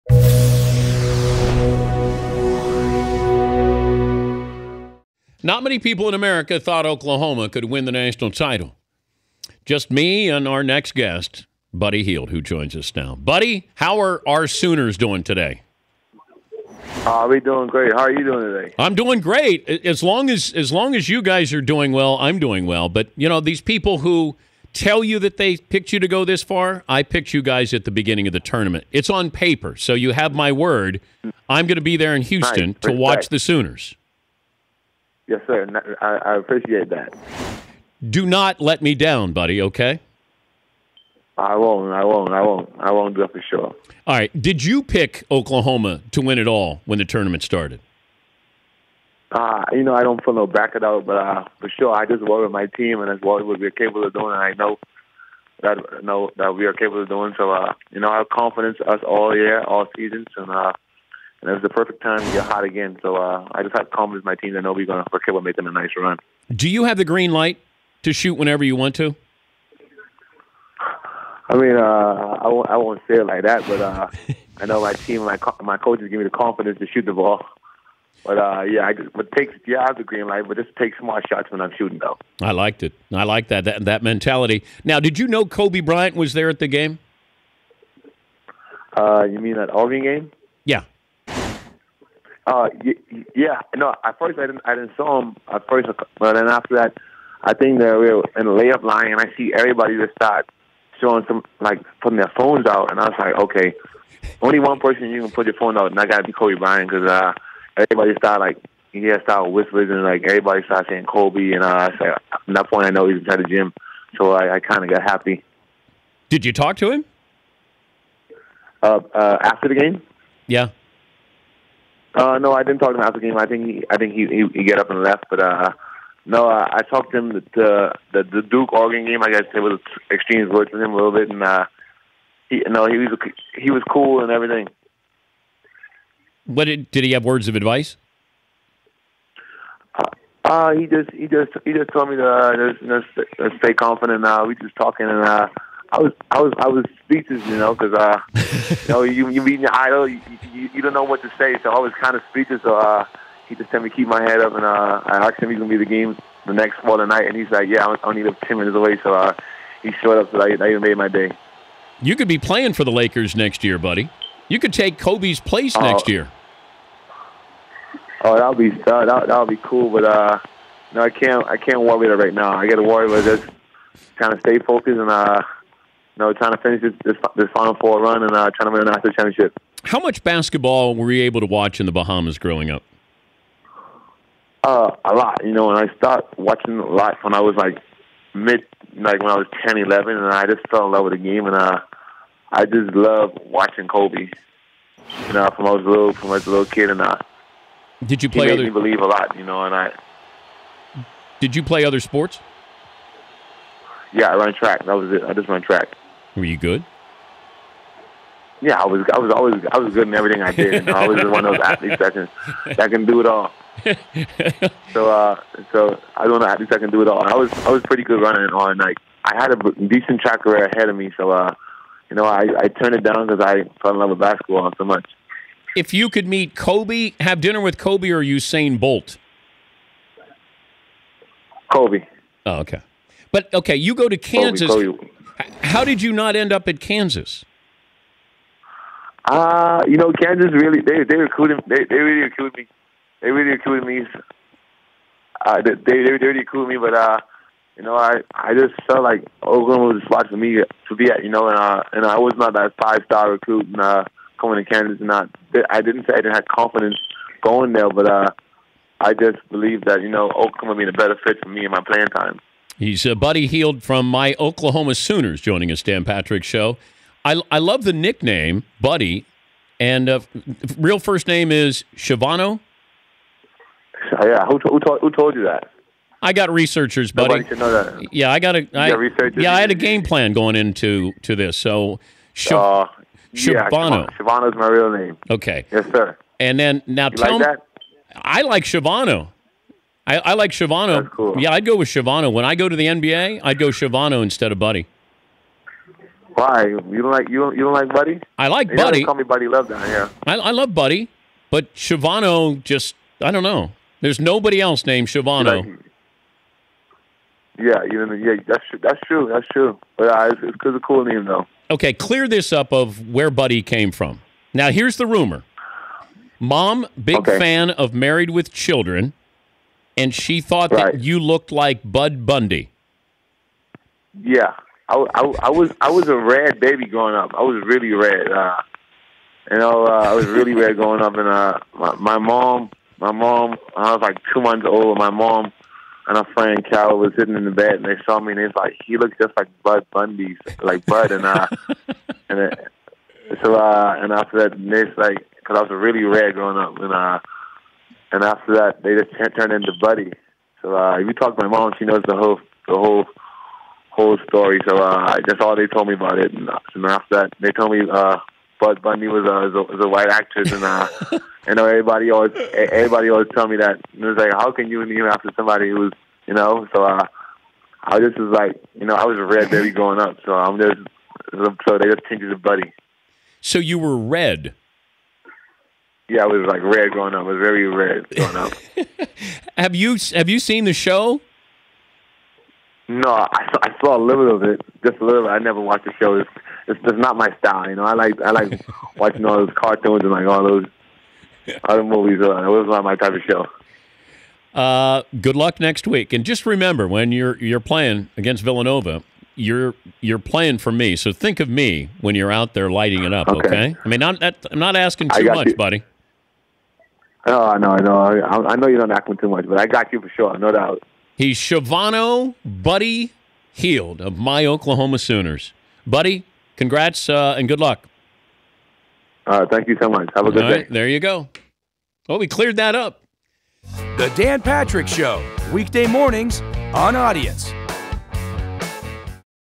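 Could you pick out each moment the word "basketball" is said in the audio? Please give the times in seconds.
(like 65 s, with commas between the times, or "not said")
180 s, 224 s.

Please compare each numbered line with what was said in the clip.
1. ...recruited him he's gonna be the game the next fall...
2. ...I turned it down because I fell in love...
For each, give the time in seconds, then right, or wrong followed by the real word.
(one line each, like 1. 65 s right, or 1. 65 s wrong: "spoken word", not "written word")
1. 155 s wrong: "asked", not "recruited"
2. 222 s right.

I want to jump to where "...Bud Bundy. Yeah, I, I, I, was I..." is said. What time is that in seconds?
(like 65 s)
321 s.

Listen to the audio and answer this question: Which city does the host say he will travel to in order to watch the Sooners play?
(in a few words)
Houston.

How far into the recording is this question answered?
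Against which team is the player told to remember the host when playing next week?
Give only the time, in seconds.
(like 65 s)
398 s.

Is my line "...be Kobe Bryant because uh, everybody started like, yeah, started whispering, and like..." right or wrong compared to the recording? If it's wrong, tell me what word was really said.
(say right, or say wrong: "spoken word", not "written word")
right.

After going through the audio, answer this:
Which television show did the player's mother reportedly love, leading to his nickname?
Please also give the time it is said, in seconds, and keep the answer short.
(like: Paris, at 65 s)
Married with Children, at 317 s.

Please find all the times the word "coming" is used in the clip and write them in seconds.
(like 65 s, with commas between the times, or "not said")
254 s.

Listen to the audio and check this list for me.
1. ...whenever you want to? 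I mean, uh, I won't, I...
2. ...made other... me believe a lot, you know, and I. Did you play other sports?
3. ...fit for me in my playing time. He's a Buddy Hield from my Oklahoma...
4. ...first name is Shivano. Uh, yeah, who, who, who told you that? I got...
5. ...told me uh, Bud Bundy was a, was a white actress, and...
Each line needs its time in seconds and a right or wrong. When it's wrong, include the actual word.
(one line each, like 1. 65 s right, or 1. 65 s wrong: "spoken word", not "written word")
1. 68 s right
2. 198 s right
3. 261 s right
4. 270 s right
5. 357 s right.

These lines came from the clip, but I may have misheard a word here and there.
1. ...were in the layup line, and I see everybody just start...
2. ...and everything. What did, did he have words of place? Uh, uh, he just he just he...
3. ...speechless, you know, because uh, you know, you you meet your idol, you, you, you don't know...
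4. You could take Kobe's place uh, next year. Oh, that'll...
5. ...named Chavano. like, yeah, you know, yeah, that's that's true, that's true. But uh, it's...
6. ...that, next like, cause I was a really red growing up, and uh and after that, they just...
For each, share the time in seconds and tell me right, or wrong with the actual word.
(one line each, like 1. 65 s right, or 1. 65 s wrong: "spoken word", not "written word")
1. 98 s right
2. 134 s wrong: "advice", not "place"
3. 147 s right
4. 164 s right
5. 304 s right
6. 344 s right.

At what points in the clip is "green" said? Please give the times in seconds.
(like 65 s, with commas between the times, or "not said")
67 s, 80 s.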